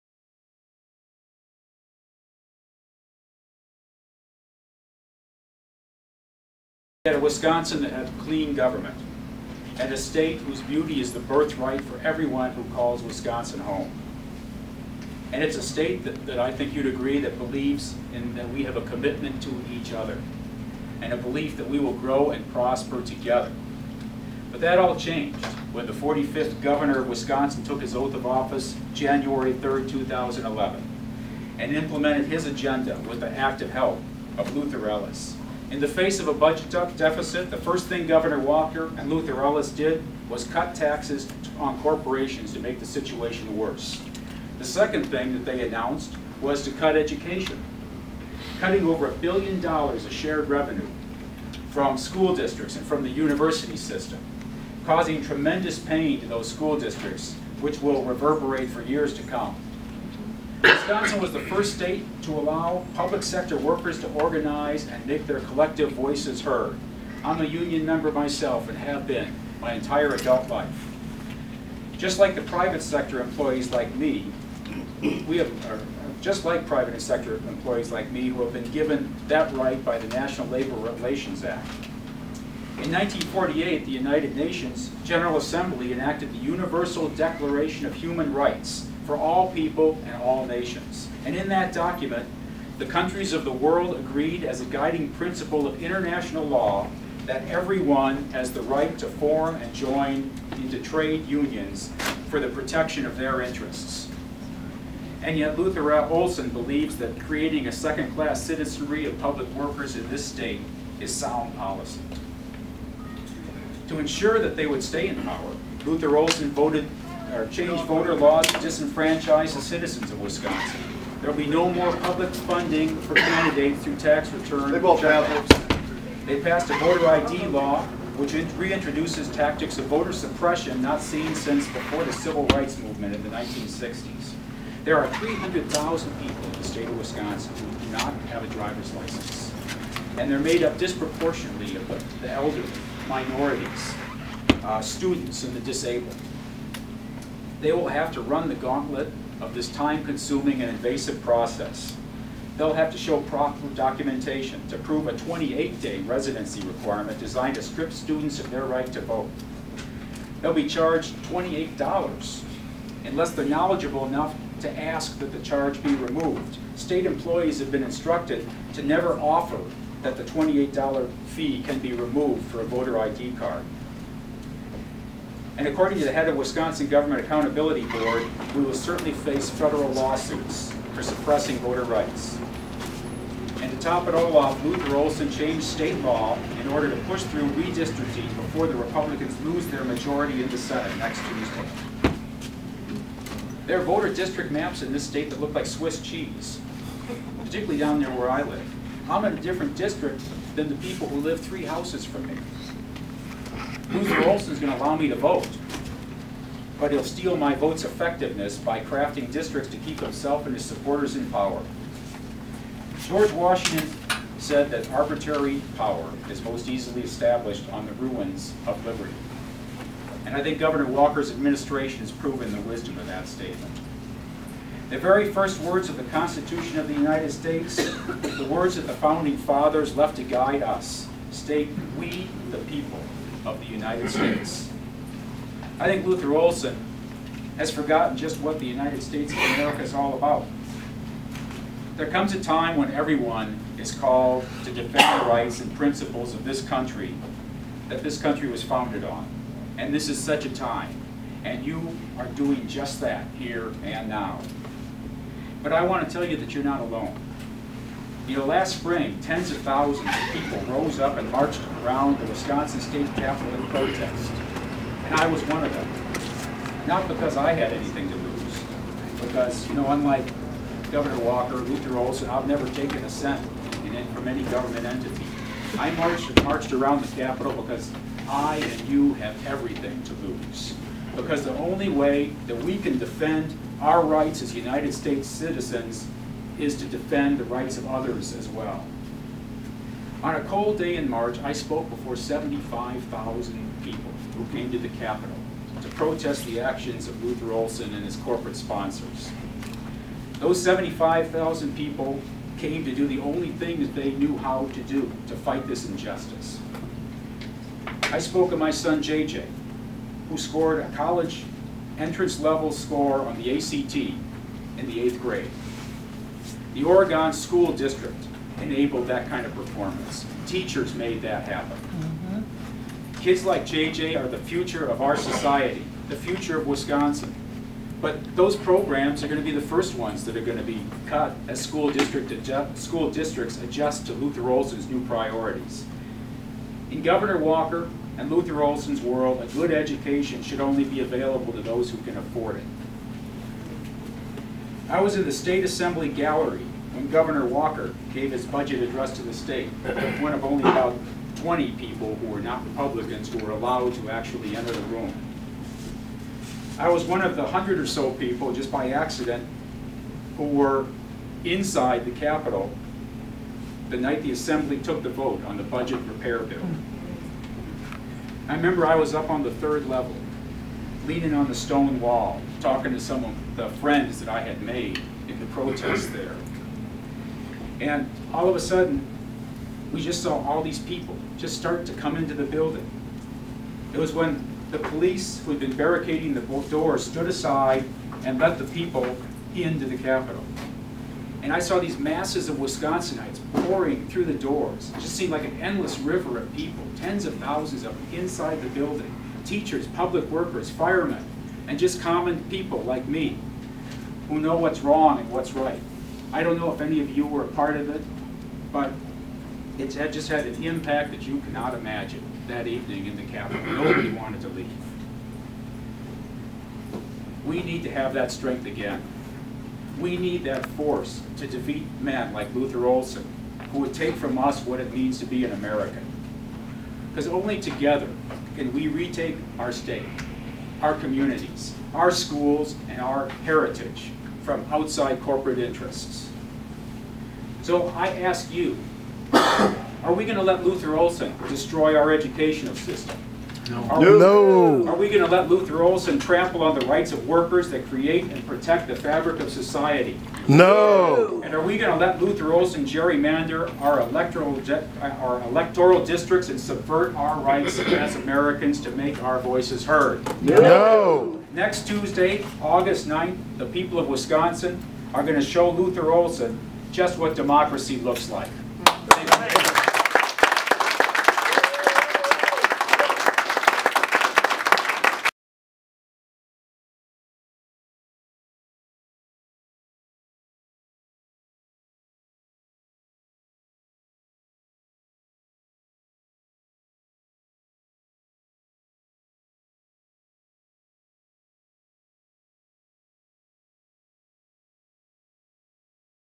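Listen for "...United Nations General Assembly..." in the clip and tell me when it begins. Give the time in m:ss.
1:23.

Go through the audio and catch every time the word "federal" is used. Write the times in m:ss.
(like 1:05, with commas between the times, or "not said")
2:59.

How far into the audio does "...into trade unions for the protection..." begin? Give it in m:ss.
1:40.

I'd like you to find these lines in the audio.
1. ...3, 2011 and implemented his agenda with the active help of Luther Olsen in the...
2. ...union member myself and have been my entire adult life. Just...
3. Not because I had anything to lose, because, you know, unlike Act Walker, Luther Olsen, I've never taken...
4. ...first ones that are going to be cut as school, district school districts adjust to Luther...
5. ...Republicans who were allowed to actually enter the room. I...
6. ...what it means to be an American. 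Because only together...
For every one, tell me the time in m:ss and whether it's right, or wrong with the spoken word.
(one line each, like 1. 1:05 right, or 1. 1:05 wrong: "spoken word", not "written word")
1. 0:29 right
2. 1:07 right
3. 4:26 wrong: "Governor", not "Act"
4. 5:29 right
5. 5:52 right
6. 7:04 right.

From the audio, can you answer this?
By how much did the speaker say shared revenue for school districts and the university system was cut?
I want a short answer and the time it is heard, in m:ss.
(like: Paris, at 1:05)
over a billion dollars, at 0:48.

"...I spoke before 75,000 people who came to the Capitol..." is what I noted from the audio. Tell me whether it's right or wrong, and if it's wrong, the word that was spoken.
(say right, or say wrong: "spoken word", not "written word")
right.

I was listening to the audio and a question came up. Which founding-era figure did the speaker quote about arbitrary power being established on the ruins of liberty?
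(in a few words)
George Washington.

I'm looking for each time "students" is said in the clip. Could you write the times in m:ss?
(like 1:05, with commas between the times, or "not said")
2:24, 2:37.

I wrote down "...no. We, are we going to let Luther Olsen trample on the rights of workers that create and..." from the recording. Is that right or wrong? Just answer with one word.
right.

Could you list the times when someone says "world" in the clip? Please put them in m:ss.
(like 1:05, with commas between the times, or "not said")
1:33, 5:39.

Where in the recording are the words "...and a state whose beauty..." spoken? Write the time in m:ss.
0:09.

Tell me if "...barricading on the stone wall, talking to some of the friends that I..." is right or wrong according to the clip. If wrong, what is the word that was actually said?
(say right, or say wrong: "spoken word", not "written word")
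wrong: "leaning", not "barricading".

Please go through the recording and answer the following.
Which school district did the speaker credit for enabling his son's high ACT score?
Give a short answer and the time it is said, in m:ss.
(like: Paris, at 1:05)
Oregon School District, at 5:16.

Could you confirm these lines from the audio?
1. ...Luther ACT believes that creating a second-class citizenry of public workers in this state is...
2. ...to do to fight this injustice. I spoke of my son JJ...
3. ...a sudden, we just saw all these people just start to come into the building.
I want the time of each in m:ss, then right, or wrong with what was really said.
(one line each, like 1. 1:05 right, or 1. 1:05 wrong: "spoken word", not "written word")
1. 1:45 wrong: "Olsen", not "ACT"
2. 5:04 right
3. 6:18 right.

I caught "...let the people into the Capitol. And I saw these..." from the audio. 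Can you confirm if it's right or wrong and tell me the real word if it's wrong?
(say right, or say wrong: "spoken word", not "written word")
right.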